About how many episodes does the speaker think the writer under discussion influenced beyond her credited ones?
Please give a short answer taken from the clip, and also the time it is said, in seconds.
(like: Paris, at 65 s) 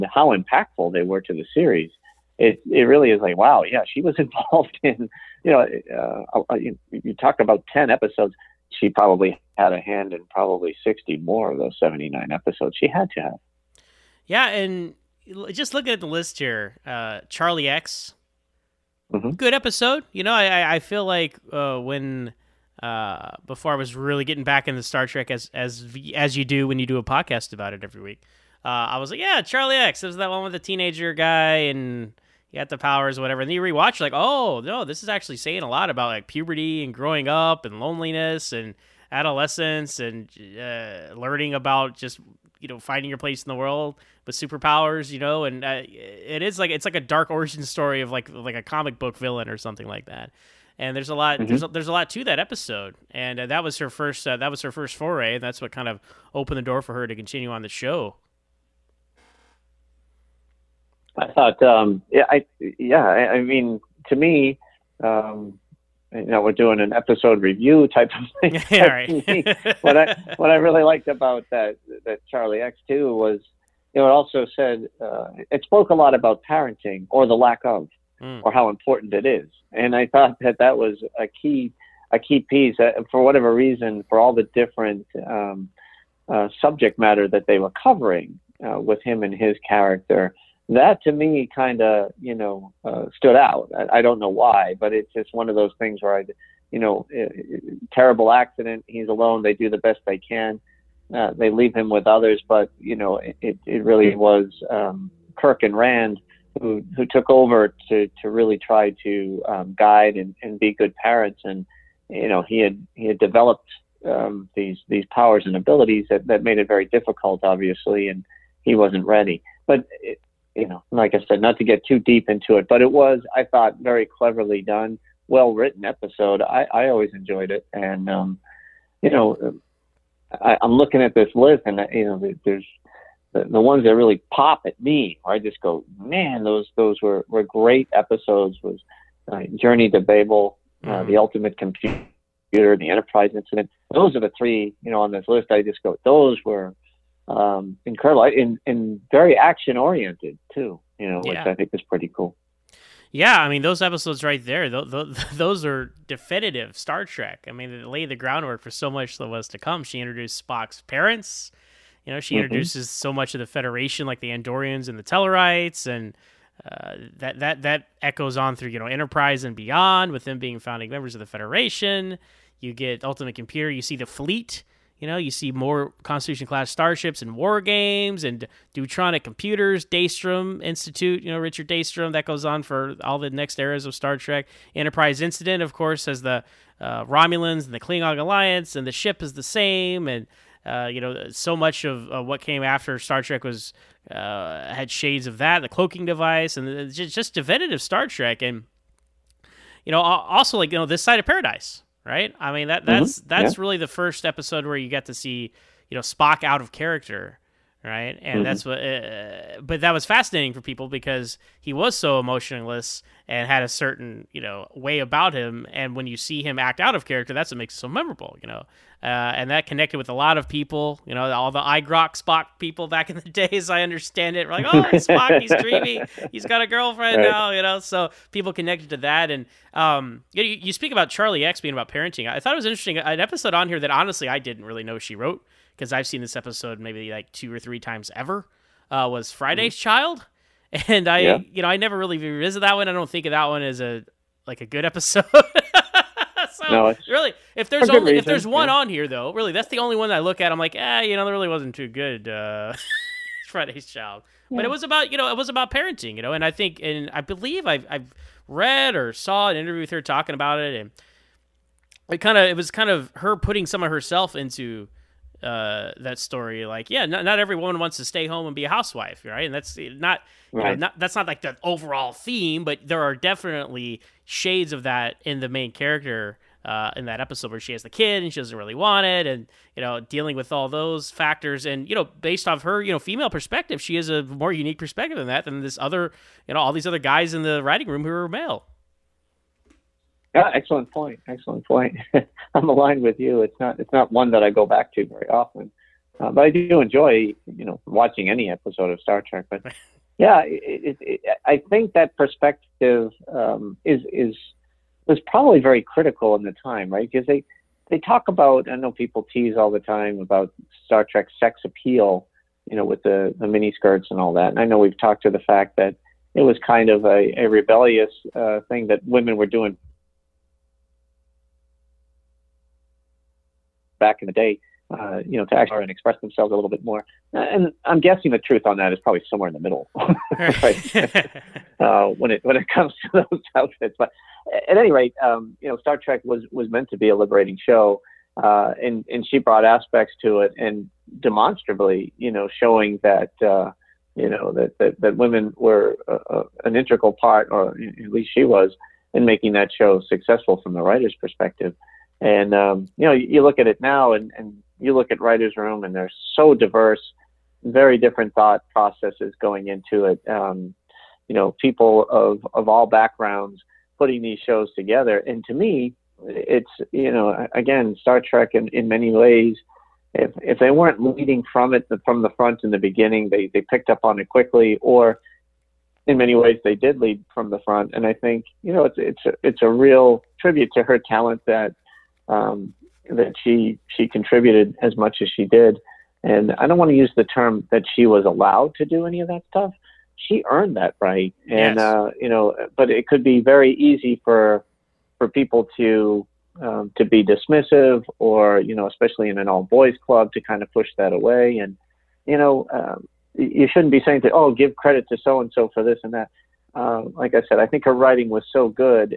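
60, at 10 s.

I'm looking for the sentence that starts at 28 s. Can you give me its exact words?
Uh, I was like, yeah, Charlie X.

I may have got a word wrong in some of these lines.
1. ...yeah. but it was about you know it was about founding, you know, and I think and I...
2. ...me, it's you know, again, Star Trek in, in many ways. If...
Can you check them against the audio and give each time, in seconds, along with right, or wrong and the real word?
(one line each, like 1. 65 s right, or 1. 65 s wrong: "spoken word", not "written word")
1. 254 s wrong: "parenting", not "founding"
2. 365 s right.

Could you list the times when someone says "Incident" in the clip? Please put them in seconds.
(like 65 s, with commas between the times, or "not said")
143 s, 185 s.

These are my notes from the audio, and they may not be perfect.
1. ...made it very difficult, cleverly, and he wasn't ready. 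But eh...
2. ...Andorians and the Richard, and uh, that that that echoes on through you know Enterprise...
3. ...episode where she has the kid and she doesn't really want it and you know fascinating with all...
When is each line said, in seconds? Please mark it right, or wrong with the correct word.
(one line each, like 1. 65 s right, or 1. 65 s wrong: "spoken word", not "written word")
1. 116 s wrong: "obviously", not "cleverly"
2. 164 s wrong: "Tellarites", not "Richard"
3. 277 s wrong: "dealing", not "fascinating".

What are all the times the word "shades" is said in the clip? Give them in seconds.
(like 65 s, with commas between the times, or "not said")
194 s, 274 s.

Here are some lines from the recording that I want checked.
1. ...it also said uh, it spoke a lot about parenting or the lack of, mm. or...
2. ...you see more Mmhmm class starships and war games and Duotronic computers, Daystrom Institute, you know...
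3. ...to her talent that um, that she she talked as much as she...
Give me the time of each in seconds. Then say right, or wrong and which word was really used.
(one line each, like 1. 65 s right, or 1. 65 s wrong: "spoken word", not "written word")
1. 74 s right
2. 175 s wrong: "Constitution", not "Mmhmm"
3. 380 s wrong: "contributed", not "talked".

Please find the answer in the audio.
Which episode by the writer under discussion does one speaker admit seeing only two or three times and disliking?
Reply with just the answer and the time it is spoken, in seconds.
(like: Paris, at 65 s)
Friday's Child, at 239 s.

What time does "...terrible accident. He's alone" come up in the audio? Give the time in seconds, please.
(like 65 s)
97 s.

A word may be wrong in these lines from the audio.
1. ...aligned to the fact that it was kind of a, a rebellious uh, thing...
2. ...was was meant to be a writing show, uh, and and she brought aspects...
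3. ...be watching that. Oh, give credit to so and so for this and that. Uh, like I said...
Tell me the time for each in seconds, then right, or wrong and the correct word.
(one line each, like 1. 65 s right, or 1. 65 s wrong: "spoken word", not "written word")
1. 314 s wrong: "talked", not "aligned"
2. 336 s wrong: "liberating", not "writing"
3. 403 s wrong: "saying", not "watching".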